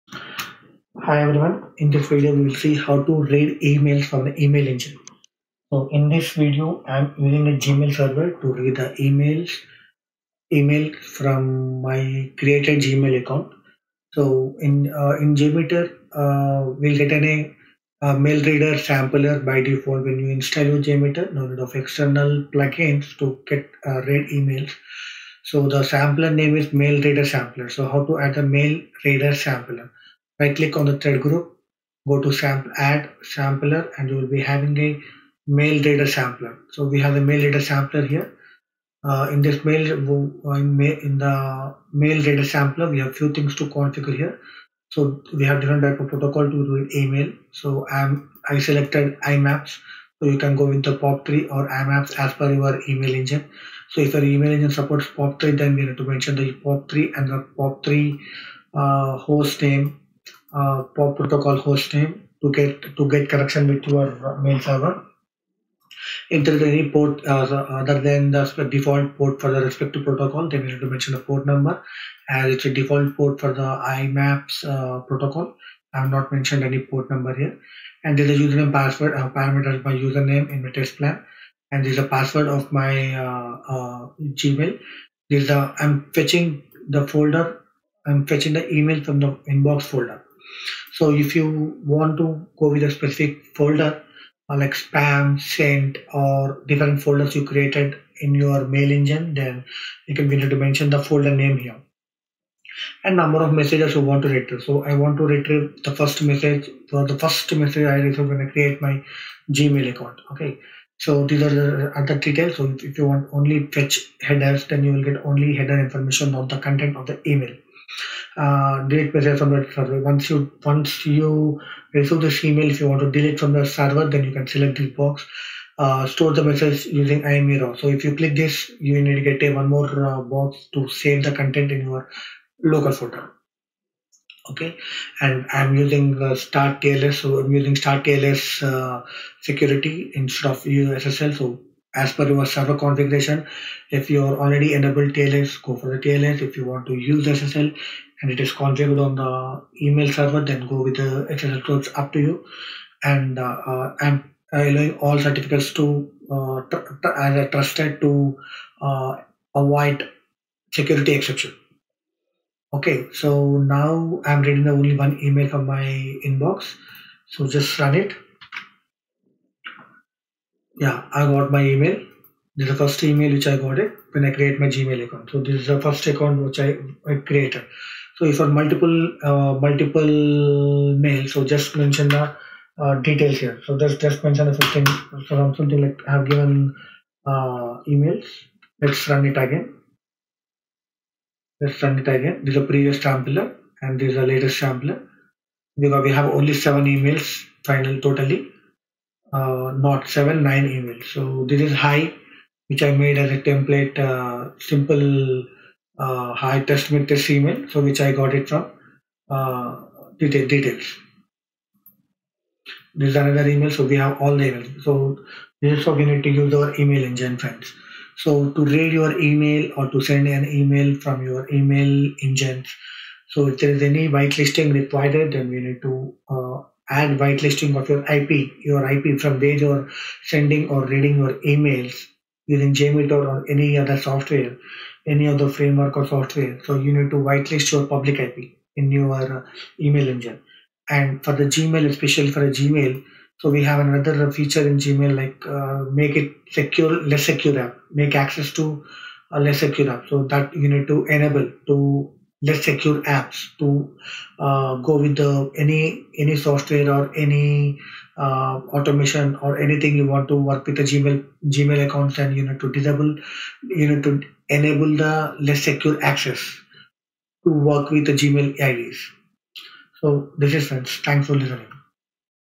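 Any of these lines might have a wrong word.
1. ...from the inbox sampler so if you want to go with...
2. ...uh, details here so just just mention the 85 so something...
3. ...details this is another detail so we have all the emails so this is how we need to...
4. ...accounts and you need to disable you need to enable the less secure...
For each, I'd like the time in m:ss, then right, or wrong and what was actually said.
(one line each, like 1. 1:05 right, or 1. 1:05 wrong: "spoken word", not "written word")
1. 1:29 wrong: "folder", not "sampler"
2. 3:02 wrong: "15", not "85"
3. 3:30 wrong: "email", not "detail"
4. 4:21 right.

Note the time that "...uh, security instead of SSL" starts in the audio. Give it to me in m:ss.
2:18.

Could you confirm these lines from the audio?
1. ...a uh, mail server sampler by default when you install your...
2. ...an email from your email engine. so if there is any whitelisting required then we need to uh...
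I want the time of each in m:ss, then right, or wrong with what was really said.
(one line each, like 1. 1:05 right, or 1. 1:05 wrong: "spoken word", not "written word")
1. 0:17 wrong: "reader", not "server"
2. 3:40 right.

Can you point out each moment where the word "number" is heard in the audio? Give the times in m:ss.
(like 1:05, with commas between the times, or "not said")
1:11, 1:17, 1:43.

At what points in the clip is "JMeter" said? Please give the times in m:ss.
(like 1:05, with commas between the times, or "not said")
0:15, 0:20, 3:52.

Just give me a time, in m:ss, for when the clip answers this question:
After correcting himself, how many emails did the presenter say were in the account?
3:20.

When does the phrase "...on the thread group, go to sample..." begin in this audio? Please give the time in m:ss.
0:30.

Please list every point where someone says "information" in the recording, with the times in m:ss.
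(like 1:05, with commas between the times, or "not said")
1:55.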